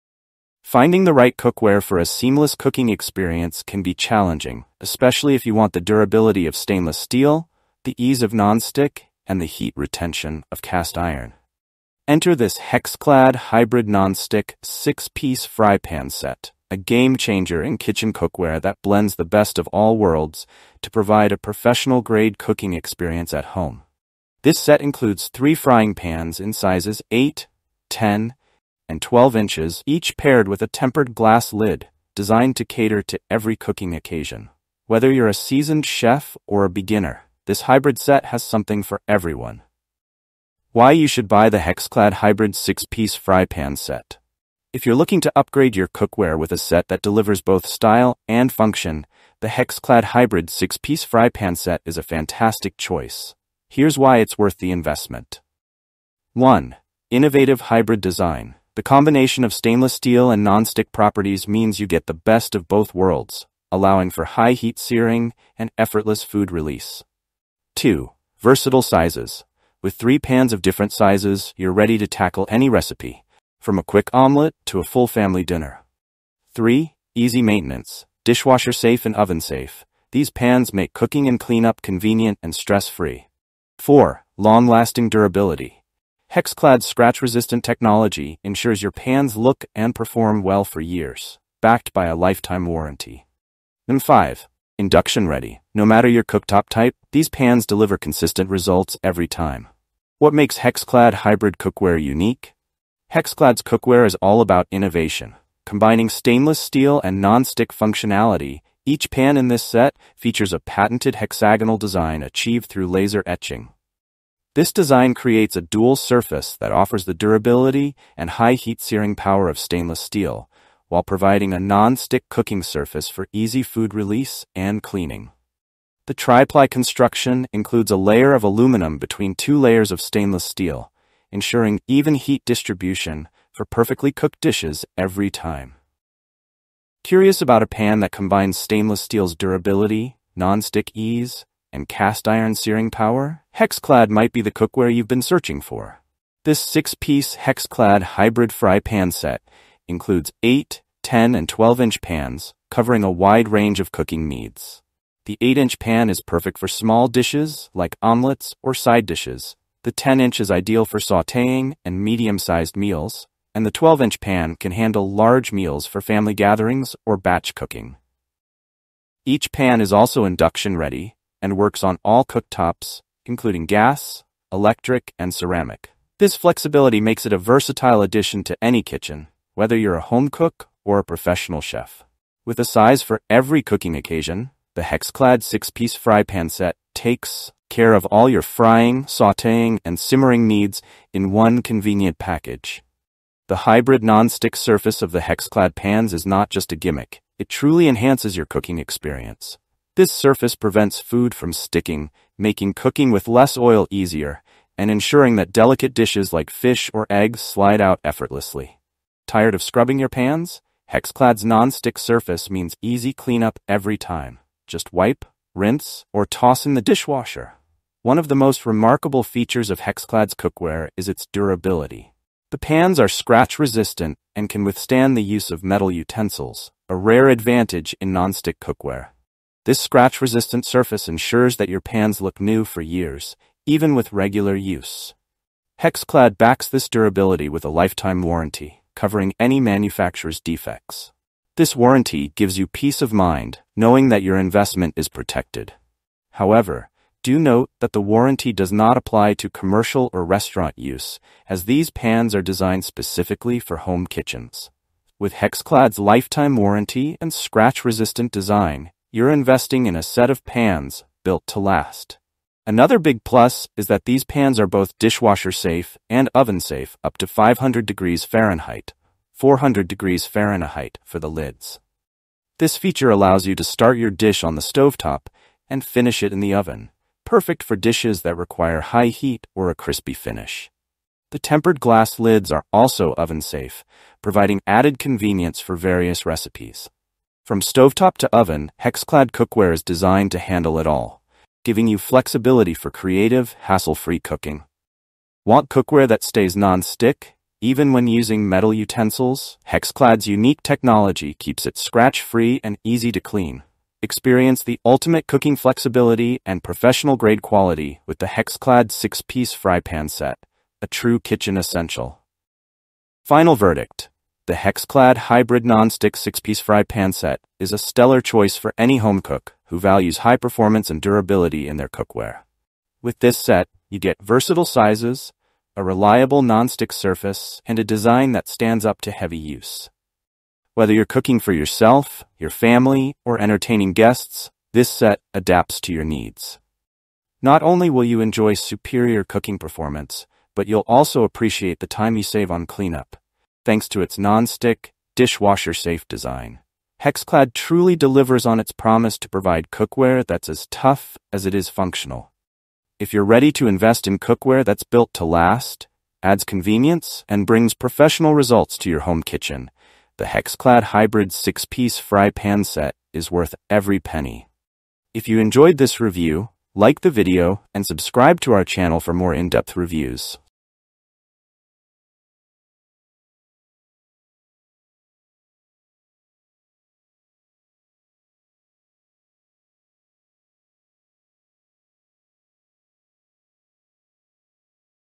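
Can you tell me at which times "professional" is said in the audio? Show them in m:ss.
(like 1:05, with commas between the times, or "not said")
0:21, 3:01, 5:06, 5:57.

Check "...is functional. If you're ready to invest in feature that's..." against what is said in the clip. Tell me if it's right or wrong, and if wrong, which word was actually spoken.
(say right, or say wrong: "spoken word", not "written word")
wrong: "cookware", not "feature".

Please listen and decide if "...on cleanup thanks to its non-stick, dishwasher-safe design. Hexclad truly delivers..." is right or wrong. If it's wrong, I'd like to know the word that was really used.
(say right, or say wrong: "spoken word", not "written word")
right.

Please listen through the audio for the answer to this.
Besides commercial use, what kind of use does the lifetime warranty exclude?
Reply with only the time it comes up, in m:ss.
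4:10.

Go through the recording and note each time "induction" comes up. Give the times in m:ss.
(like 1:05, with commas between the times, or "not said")
1:34, 2:50.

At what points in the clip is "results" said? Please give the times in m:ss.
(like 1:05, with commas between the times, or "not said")
1:38, 5:58.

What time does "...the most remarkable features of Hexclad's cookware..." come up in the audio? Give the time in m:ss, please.
3:38.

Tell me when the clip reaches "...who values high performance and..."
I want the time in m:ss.
5:19.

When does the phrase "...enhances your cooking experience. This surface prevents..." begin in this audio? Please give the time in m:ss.
3:17.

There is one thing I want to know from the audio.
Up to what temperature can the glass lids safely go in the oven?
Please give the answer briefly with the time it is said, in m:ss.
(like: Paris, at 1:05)
400 degrees Fahrenheit, at 4:29.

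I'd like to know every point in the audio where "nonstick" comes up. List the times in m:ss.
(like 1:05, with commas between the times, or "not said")
0:08, 0:13, 5:15, 5:26.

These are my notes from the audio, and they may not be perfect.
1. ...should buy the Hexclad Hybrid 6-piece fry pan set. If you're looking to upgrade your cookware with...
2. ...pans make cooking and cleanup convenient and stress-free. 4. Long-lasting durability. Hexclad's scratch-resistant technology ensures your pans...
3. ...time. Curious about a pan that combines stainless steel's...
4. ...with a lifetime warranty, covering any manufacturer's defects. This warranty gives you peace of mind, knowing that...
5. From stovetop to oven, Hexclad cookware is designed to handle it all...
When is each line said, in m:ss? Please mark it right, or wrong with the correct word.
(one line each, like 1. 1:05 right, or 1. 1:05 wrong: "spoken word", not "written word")
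1. 0:41 right
2. 1:20 right
3. 2:15 right
4. 3:57 right
5. 4:47 right.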